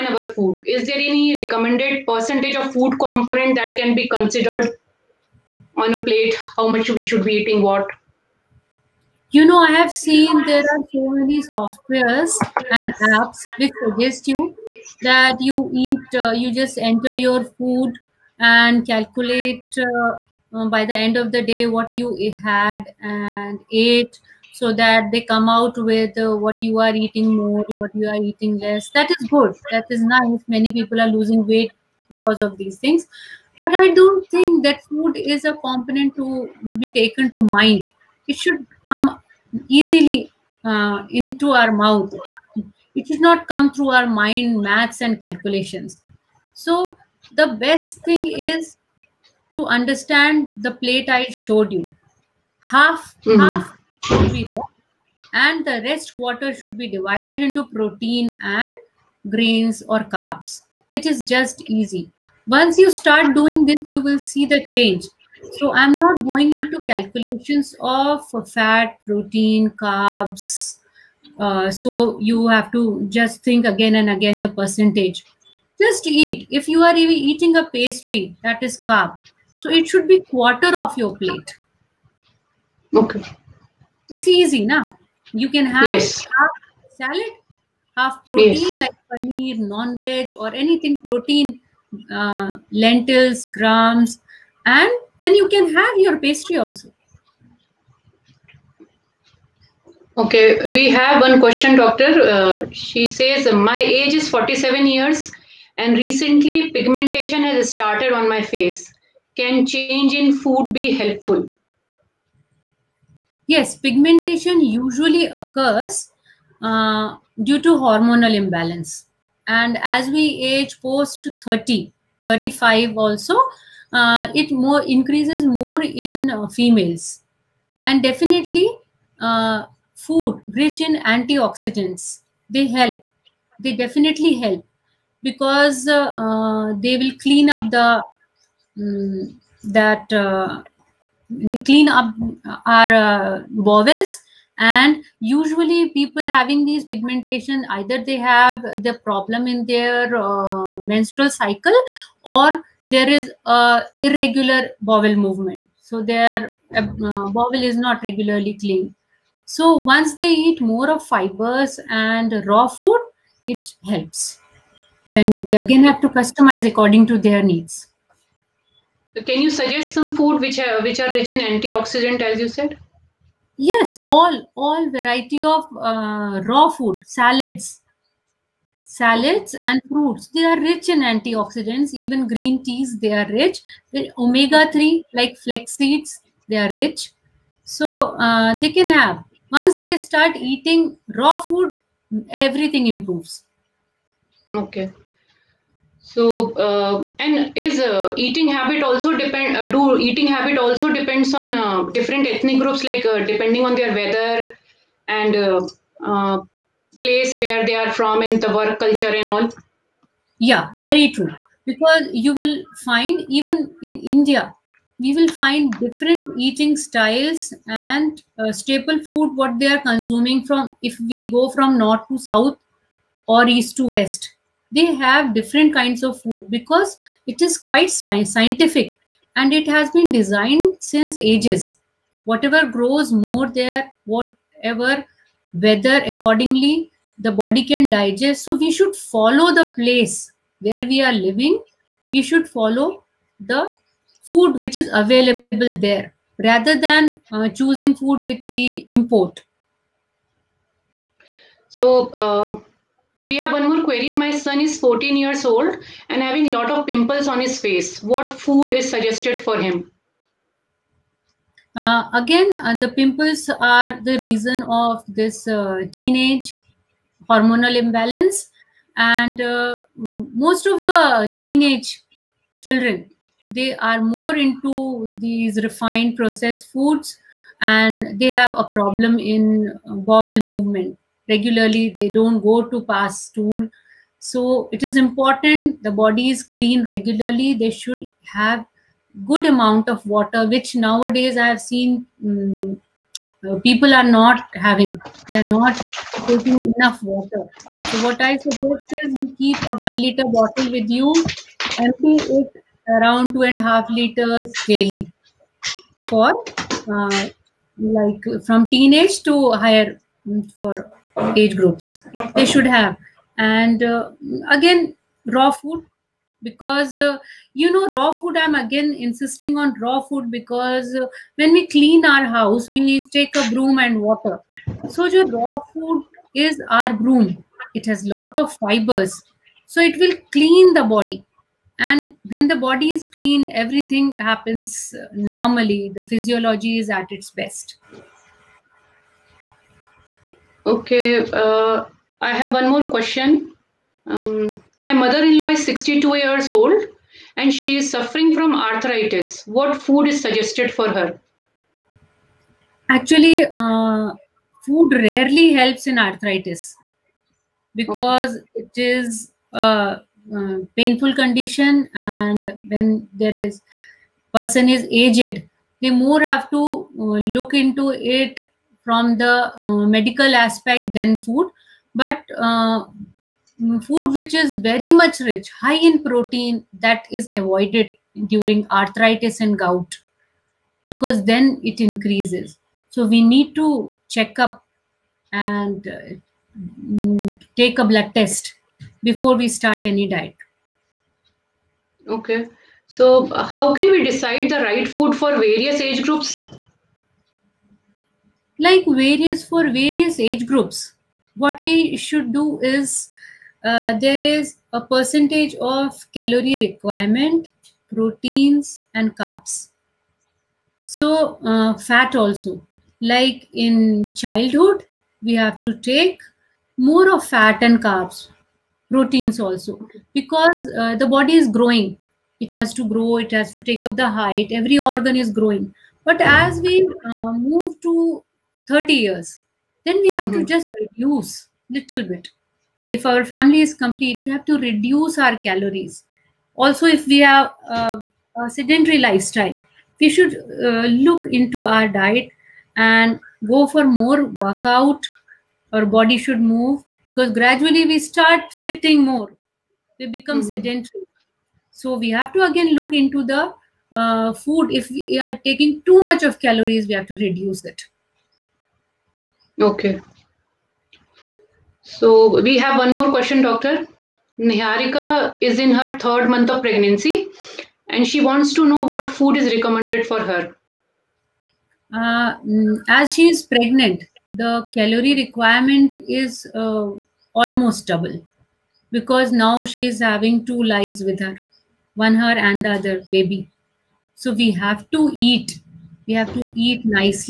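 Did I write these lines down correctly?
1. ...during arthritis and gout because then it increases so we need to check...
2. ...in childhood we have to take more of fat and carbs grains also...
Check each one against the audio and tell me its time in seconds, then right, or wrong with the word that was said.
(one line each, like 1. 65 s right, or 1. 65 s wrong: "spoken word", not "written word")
1. 378 s right
2. 413 s wrong: "proteins", not "grains".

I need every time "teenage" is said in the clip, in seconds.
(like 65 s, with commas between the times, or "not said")
265 s, 271 s, 308 s.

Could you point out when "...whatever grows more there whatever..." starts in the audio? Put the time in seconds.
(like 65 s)
232 s.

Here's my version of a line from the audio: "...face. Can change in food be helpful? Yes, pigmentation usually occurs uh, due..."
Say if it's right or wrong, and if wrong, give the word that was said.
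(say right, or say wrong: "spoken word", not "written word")
right.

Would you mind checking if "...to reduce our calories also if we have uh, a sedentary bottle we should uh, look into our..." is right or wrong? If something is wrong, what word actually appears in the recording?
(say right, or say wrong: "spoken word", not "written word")
wrong: "lifestyle", not "bottle".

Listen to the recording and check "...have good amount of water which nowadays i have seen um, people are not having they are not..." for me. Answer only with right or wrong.
right.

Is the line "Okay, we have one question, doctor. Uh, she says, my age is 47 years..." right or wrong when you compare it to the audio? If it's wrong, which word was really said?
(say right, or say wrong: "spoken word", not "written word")
right.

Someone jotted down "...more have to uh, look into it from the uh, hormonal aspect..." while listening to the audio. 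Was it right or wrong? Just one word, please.
wrong.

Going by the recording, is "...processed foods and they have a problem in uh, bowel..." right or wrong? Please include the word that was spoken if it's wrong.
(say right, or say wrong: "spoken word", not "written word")
right.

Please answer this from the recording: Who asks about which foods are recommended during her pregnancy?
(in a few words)
Niharika.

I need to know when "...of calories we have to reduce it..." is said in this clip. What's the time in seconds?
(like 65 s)
456 s.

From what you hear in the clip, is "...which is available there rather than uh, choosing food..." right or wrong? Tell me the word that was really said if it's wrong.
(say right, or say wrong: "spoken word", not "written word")
right.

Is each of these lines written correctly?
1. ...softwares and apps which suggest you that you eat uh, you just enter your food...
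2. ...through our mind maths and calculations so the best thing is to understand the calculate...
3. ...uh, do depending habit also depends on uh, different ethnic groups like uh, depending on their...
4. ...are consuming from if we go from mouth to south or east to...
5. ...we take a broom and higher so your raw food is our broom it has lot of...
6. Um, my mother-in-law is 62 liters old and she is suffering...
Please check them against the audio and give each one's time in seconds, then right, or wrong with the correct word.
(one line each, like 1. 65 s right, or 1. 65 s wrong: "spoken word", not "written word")
1. 11 s right
2. 43 s wrong: "plate", not "calculate"
3. 199 s wrong: "eating", not "depending"
4. 219 s wrong: "north", not "mouth"
5. 322 s wrong: "water", not "higher"
6. 344 s wrong: "years", not "liters".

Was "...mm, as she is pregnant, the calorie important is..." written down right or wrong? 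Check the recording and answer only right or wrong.
wrong.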